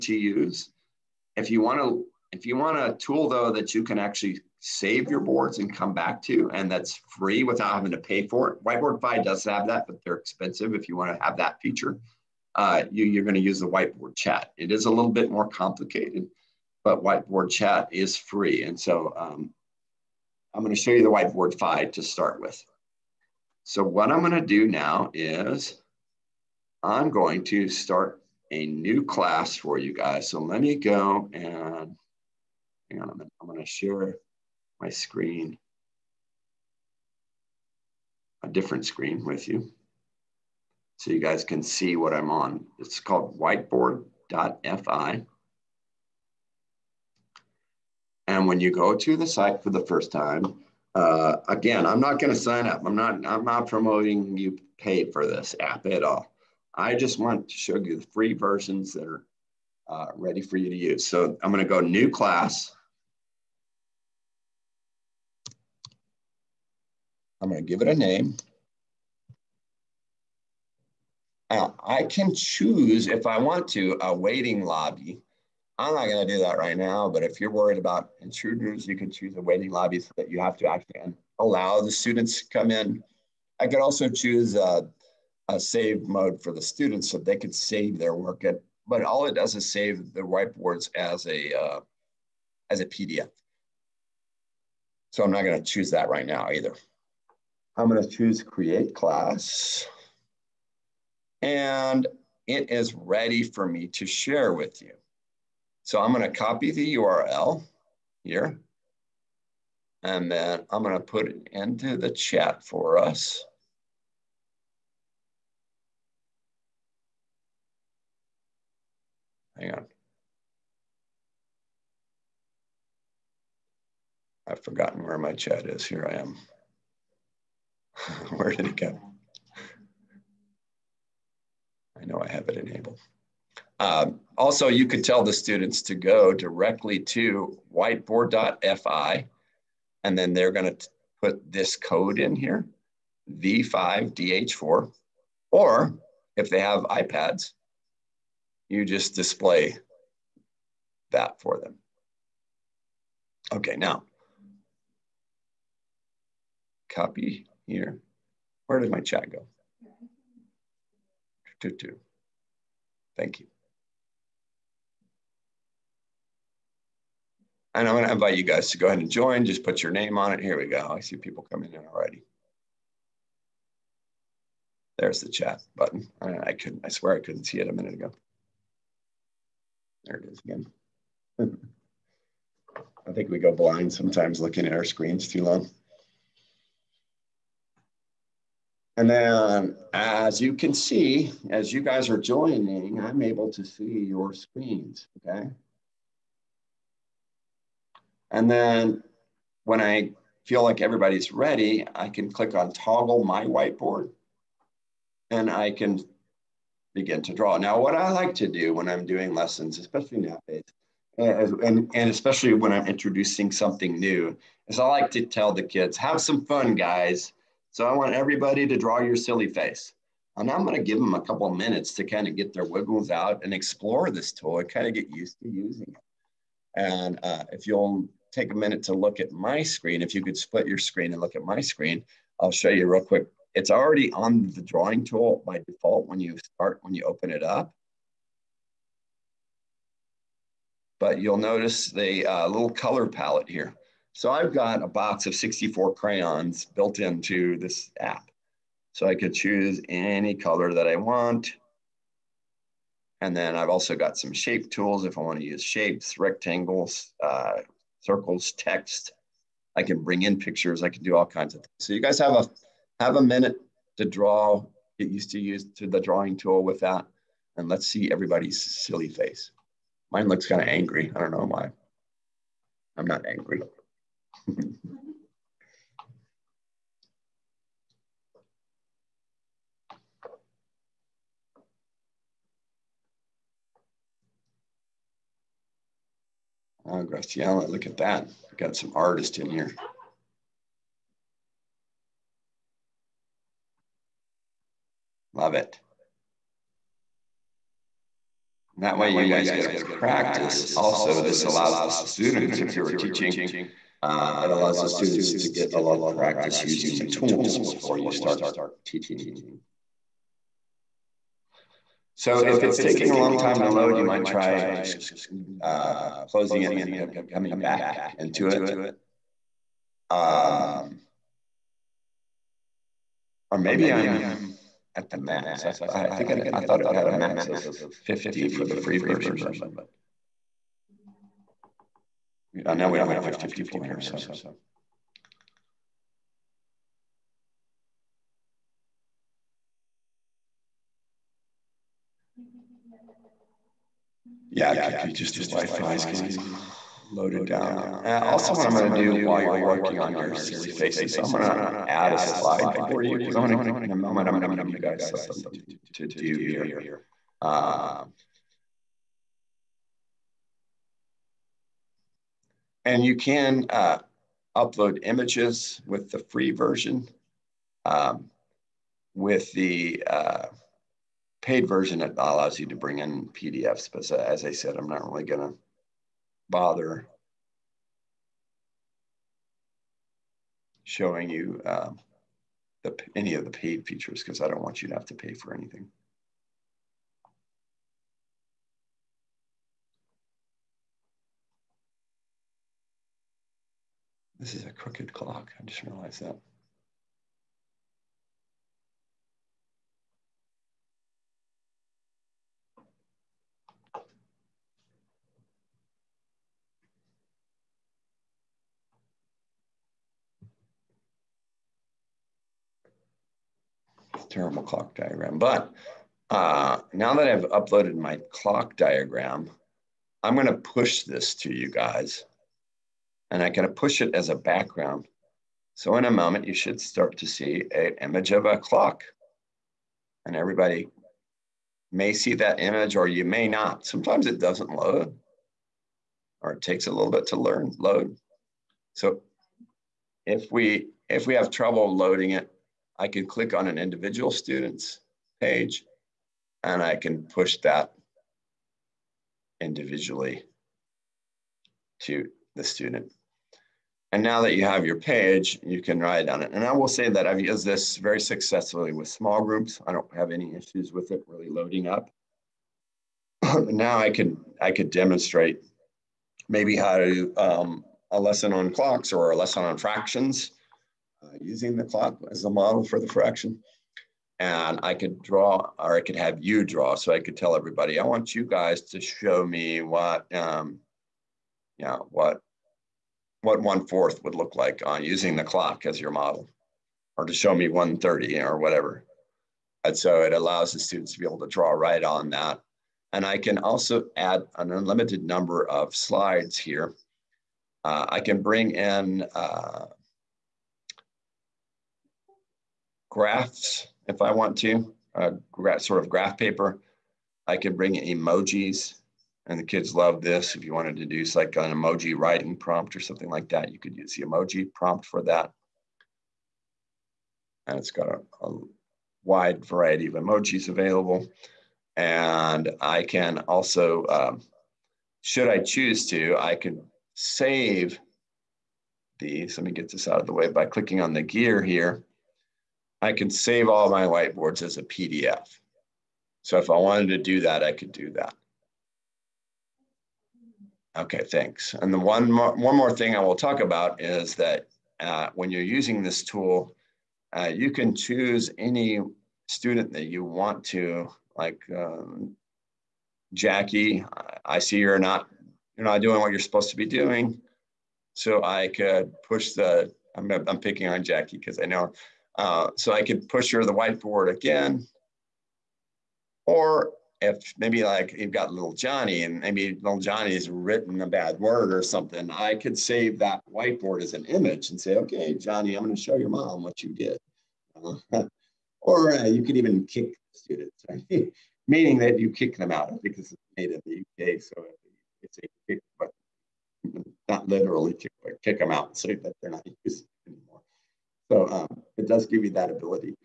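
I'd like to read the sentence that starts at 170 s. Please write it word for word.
I see people coming in already.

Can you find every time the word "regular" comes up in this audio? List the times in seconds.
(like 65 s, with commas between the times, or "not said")
not said.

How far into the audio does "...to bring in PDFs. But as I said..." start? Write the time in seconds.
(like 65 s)
372 s.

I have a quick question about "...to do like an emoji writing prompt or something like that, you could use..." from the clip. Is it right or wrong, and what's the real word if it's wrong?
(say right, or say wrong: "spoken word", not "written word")
right.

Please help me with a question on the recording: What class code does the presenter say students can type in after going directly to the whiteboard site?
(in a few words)
V5DH4.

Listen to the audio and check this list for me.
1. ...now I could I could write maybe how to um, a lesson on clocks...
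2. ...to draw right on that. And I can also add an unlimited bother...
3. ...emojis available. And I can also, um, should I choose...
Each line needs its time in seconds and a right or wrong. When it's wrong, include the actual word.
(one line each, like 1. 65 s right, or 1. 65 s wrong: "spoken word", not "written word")
1. 463 s wrong: "demonstrate", not "write"
2. 491 s wrong: "number", not "bother"
3. 520 s right.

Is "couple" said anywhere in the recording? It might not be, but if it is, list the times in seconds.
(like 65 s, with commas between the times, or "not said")
221 s.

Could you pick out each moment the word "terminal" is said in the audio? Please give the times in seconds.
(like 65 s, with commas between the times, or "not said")
414 s.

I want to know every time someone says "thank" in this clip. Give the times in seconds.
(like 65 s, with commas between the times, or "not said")
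163 s, 541 s.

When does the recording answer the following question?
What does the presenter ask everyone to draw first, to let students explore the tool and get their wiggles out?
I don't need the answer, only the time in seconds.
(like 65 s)
219 s.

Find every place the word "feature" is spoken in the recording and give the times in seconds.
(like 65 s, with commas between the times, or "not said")
11 s, 383 s.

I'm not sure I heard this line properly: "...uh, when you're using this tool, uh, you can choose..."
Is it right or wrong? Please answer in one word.
right.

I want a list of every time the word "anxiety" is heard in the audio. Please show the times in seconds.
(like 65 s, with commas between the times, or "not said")
not said.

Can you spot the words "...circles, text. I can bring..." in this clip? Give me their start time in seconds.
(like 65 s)
258 s.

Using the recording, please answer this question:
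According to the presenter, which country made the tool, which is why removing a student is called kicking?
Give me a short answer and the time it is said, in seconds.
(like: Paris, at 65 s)
UK, at 583 s.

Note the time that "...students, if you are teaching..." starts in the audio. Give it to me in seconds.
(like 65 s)
301 s.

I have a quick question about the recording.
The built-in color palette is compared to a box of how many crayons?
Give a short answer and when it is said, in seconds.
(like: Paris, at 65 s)
64, at 245 s.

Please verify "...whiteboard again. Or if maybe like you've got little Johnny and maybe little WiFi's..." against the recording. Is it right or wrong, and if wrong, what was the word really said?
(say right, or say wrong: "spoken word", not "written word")
wrong: "Johnny", not "WiFi".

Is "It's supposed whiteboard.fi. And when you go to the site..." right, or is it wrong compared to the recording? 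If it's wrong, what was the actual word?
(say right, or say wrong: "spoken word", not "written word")
wrong: "called", not "supposed".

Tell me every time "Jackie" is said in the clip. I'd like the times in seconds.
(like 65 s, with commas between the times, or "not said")
553 s, 561 s.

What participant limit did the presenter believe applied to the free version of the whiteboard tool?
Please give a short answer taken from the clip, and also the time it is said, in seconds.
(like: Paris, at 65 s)
50, at 327 s.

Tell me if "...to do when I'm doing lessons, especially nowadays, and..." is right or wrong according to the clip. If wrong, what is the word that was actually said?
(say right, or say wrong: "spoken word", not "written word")
right.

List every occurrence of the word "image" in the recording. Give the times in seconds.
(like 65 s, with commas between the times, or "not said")
365 s, 428 s, 432 s, 574 s.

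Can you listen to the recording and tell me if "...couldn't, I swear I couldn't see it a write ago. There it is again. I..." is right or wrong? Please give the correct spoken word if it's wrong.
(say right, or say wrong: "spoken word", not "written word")
wrong: "minute", not "write".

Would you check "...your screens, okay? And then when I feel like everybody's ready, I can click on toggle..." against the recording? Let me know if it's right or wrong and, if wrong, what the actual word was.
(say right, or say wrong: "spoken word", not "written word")
right.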